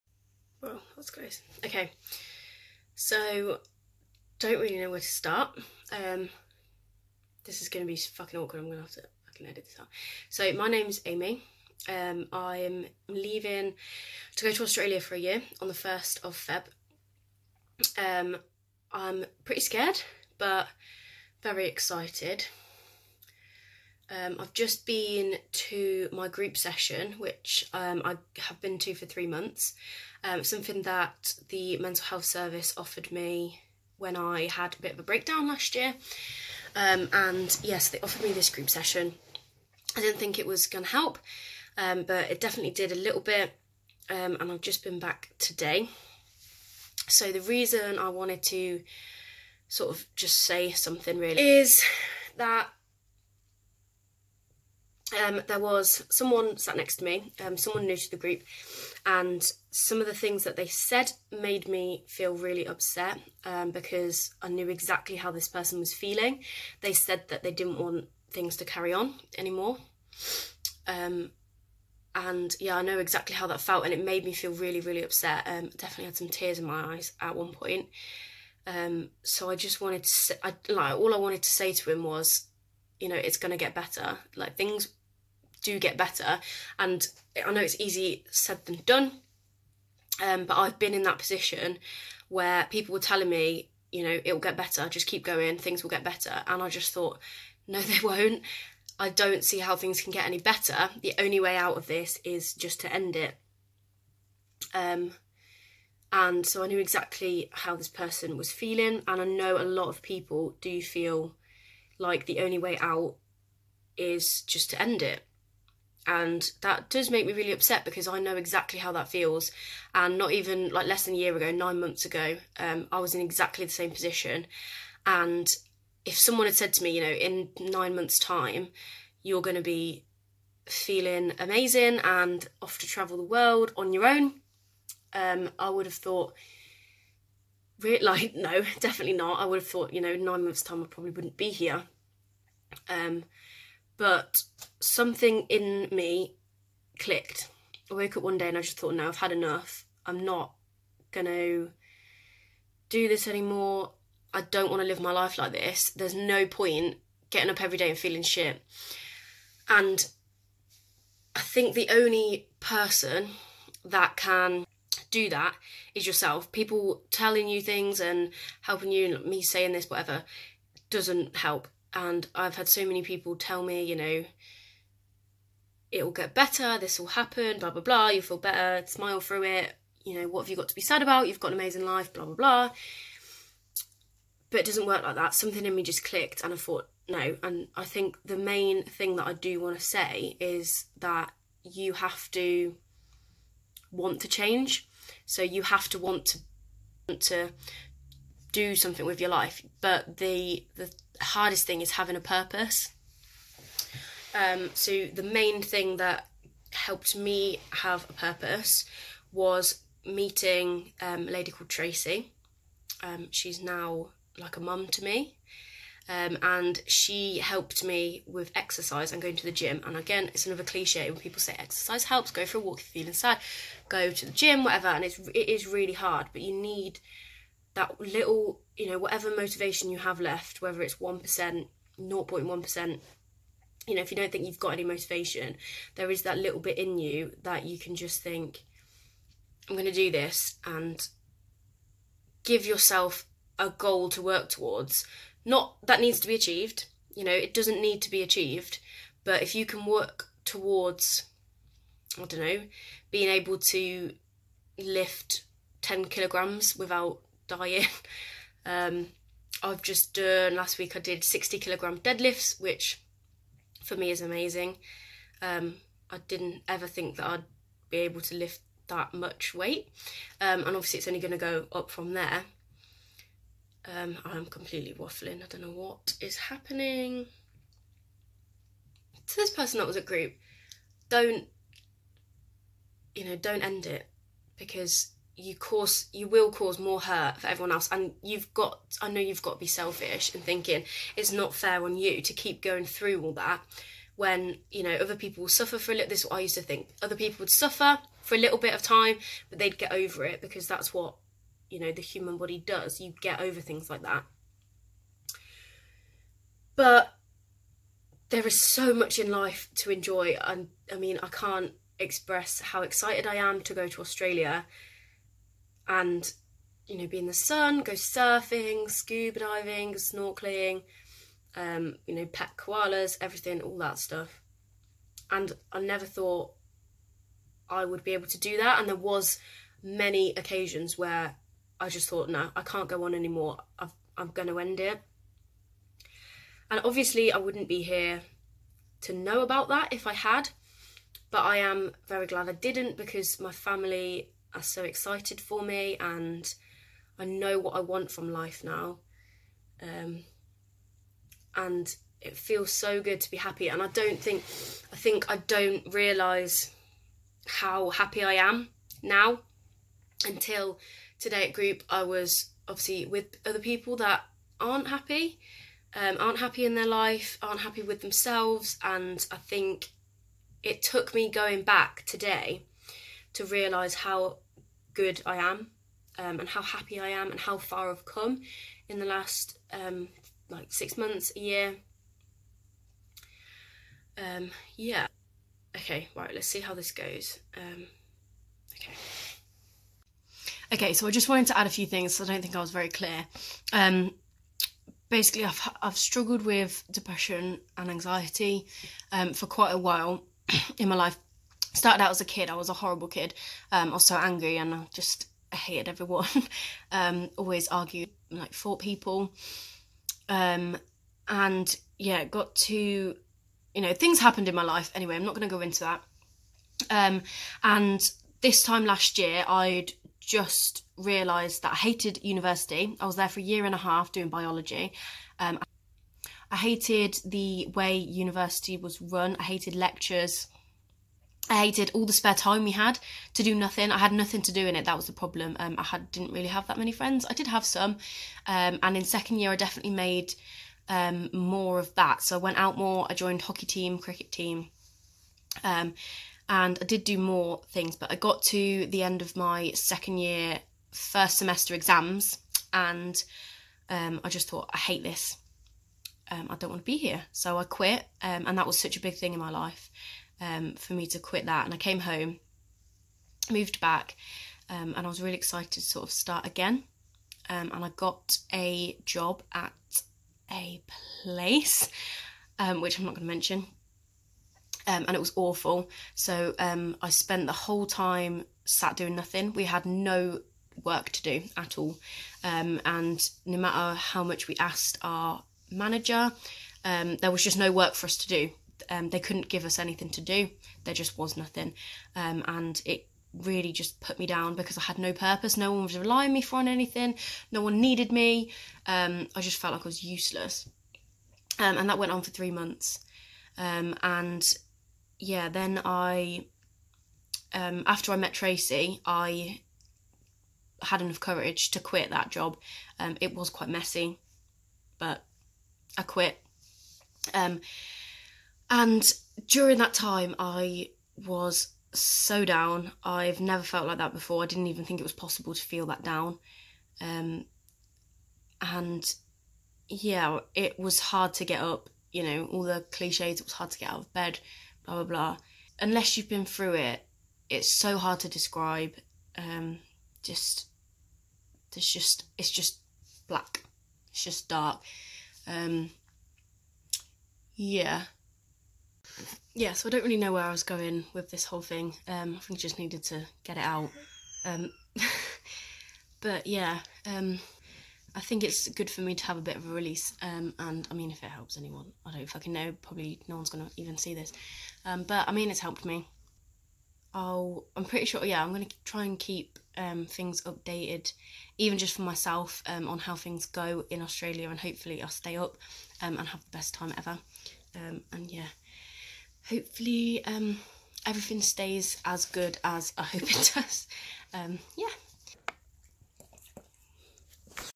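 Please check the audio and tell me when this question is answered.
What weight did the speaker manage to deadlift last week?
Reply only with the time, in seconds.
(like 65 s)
261 s.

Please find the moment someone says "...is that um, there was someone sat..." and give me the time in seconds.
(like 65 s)
51 s.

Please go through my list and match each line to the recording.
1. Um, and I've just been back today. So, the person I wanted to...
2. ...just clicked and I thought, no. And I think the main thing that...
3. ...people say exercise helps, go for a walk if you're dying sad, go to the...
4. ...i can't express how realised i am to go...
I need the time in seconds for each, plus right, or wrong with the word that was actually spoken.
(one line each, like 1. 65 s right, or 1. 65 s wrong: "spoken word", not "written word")
1. 44 s wrong: "reason", not "person"
2. 185 s right
3. 221 s wrong: "feeling", not "dying"
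4. 311 s wrong: "excited", not "realised".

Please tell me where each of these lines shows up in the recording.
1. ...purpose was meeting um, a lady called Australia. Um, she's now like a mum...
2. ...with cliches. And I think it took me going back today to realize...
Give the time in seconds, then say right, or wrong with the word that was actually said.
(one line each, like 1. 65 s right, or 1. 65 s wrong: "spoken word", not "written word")
1. 208 s wrong: "Tracy", not "Australia"
2. 367 s wrong: "themselves", not "cliches".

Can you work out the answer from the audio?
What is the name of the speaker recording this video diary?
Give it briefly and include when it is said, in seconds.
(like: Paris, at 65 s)
Amy, at 11 s.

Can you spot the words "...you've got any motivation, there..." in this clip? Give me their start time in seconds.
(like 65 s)
234 s.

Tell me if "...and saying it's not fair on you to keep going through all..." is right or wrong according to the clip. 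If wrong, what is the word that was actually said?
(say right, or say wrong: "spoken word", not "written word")
wrong: "thinking", not "saying".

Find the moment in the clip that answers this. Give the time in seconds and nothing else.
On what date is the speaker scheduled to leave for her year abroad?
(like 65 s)
15 s.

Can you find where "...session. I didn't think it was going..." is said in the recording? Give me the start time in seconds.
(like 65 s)
38 s.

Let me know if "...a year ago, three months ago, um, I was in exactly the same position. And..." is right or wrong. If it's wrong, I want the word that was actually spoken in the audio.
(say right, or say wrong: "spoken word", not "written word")
wrong: "nine", not "three".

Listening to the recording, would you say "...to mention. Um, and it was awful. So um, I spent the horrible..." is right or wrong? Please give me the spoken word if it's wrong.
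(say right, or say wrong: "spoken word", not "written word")
wrong: "whole", not "horrible".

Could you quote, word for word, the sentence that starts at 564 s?
Um, but I mean, it's helped me.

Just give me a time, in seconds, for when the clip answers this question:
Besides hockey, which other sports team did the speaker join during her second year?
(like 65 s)
443 s.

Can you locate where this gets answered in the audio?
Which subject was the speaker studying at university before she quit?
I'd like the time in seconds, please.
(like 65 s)
424 s.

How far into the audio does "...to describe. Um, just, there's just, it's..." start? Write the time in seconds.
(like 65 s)
538 s.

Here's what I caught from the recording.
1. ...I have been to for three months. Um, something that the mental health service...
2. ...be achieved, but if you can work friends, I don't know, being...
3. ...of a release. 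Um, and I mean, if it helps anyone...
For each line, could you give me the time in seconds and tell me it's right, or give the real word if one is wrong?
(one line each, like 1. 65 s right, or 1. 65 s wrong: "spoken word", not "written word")
1. 28 s right
2. 248 s wrong: "towards", not "friends"
3. 559 s right.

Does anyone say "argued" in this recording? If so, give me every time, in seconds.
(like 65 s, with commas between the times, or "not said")
407 s.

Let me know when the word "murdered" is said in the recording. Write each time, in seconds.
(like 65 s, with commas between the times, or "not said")
not said.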